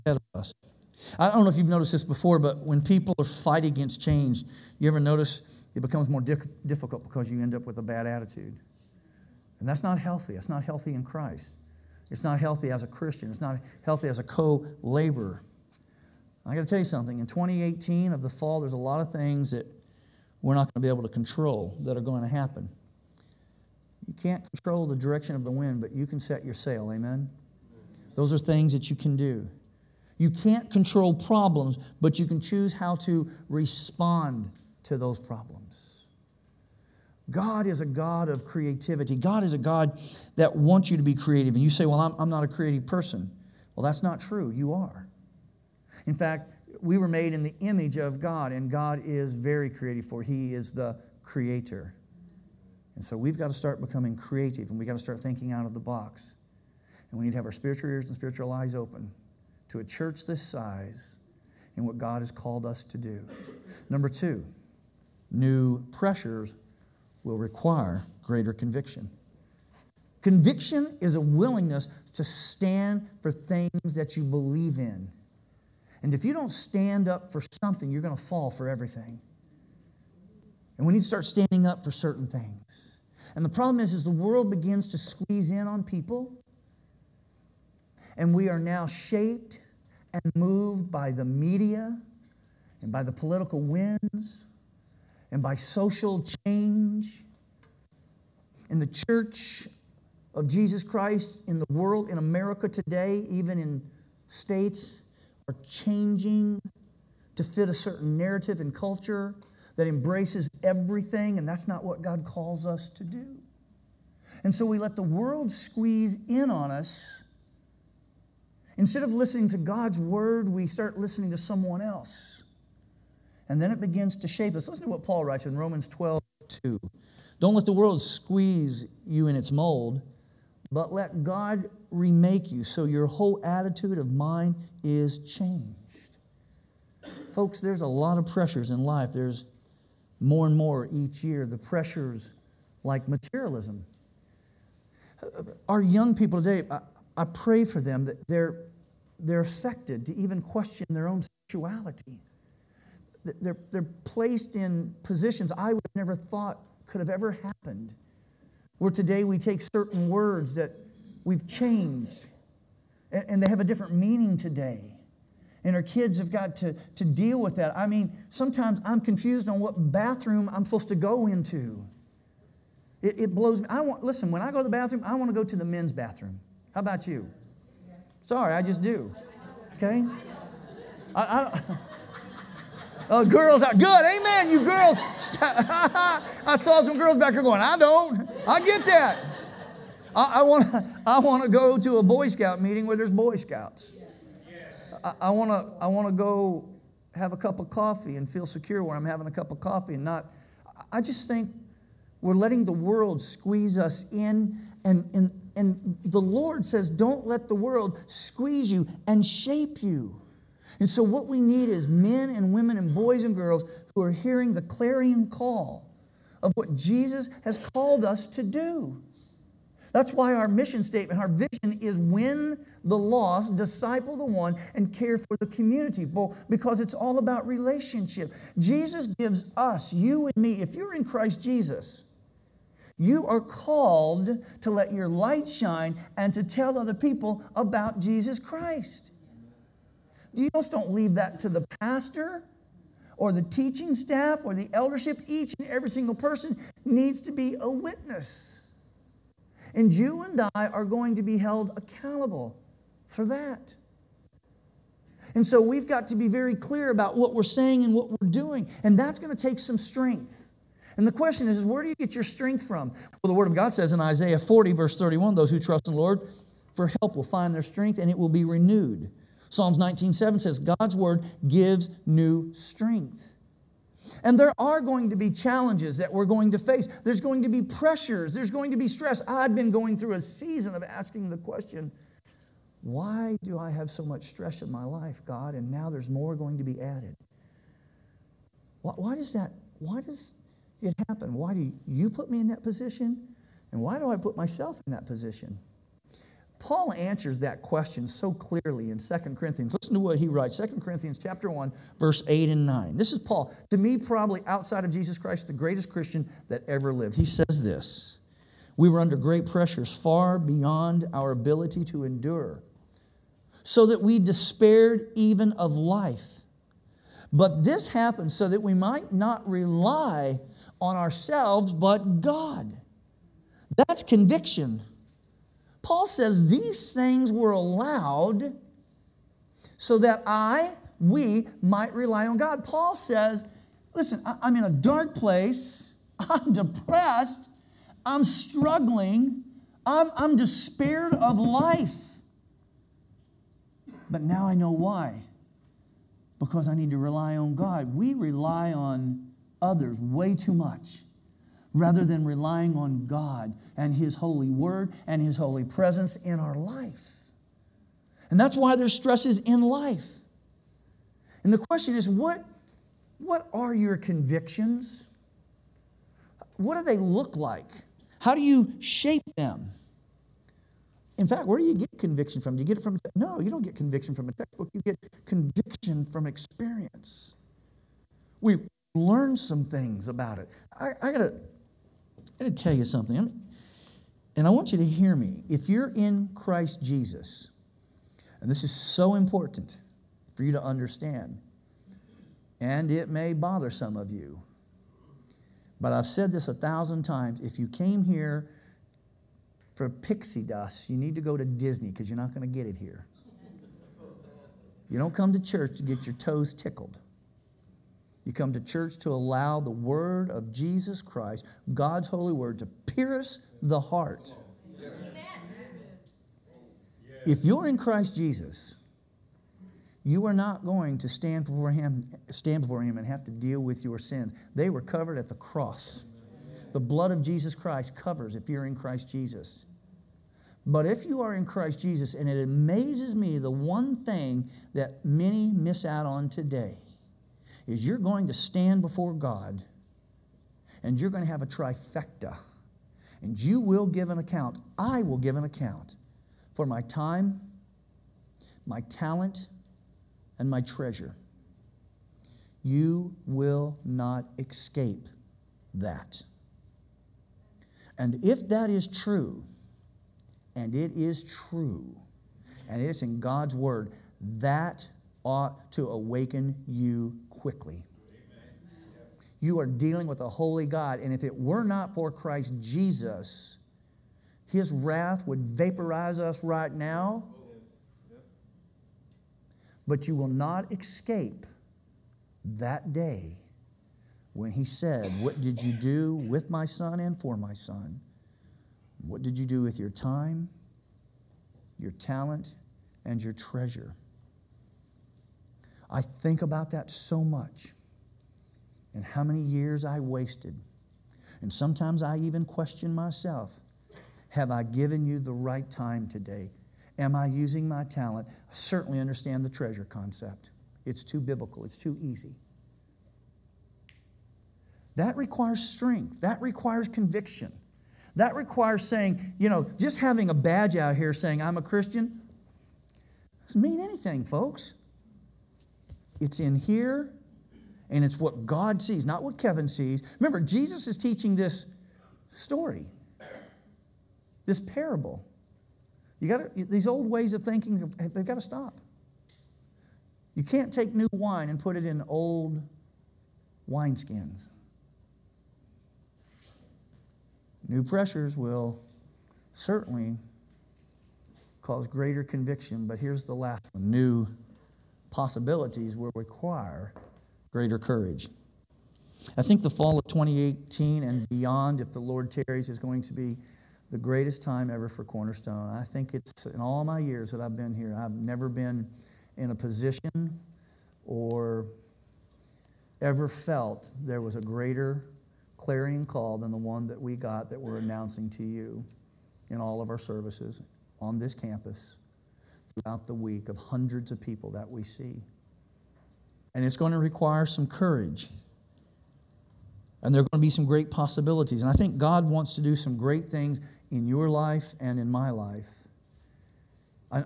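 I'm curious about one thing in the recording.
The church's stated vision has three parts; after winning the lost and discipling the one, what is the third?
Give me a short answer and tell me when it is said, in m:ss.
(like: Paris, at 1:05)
care for the community, at 3:44.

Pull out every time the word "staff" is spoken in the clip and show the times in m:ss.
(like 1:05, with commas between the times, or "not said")
4:03.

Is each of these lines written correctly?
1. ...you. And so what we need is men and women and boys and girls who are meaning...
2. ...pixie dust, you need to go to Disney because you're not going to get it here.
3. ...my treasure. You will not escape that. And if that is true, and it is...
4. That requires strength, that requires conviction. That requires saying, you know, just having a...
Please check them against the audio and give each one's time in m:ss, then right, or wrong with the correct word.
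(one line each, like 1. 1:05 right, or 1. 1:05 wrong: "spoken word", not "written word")
1. 3:29 wrong: "hearing", not "meaning"
2. 6:39 right
3. 7:30 right
4. 8:34 right.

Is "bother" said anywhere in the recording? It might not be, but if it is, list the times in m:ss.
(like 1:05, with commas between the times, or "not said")
6:33.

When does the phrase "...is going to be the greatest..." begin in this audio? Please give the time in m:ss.
9:22.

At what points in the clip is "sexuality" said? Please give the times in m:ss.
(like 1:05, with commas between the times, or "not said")
2:31.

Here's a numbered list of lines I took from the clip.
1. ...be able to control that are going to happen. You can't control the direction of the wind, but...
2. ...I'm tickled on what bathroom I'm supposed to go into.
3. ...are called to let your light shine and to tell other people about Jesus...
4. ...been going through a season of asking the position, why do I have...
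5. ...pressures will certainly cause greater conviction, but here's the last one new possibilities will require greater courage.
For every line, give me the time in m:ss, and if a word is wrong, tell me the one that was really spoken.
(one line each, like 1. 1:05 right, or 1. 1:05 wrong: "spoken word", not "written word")
1. 0:20 right
2. 2:48 wrong: "confused", not "tickled"
3. 3:53 right
4. 4:39 wrong: "question", not "position"
5. 9:07 right.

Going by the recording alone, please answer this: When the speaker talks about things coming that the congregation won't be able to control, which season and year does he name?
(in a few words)
fall of 2018.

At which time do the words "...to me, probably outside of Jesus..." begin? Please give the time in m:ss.
5:03.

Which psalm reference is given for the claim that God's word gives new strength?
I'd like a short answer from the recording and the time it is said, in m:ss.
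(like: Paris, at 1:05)
Psalm 19:7, at 4:29.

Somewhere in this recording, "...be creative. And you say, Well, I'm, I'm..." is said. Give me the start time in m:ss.
0:41.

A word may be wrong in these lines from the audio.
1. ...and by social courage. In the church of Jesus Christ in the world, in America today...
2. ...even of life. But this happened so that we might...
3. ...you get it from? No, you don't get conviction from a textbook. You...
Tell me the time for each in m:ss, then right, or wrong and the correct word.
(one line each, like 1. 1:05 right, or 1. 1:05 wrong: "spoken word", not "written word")
1. 1:35 wrong: "change", not "courage"
2. 5:15 right
3. 6:12 right.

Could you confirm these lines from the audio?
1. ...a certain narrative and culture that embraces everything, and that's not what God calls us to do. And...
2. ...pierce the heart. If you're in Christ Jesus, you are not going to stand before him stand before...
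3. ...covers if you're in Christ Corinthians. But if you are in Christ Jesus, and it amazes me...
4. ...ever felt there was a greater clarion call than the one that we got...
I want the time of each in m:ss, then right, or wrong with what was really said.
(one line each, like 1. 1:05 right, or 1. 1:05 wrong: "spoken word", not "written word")
1. 1:47 right
2. 6:52 right
3. 7:07 wrong: "Jesus", not "Corinthians"
4. 9:33 right.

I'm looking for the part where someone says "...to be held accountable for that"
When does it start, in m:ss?
4:11.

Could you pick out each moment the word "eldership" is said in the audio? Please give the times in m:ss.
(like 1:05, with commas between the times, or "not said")
4:04.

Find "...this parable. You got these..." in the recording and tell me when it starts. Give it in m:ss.
8:54.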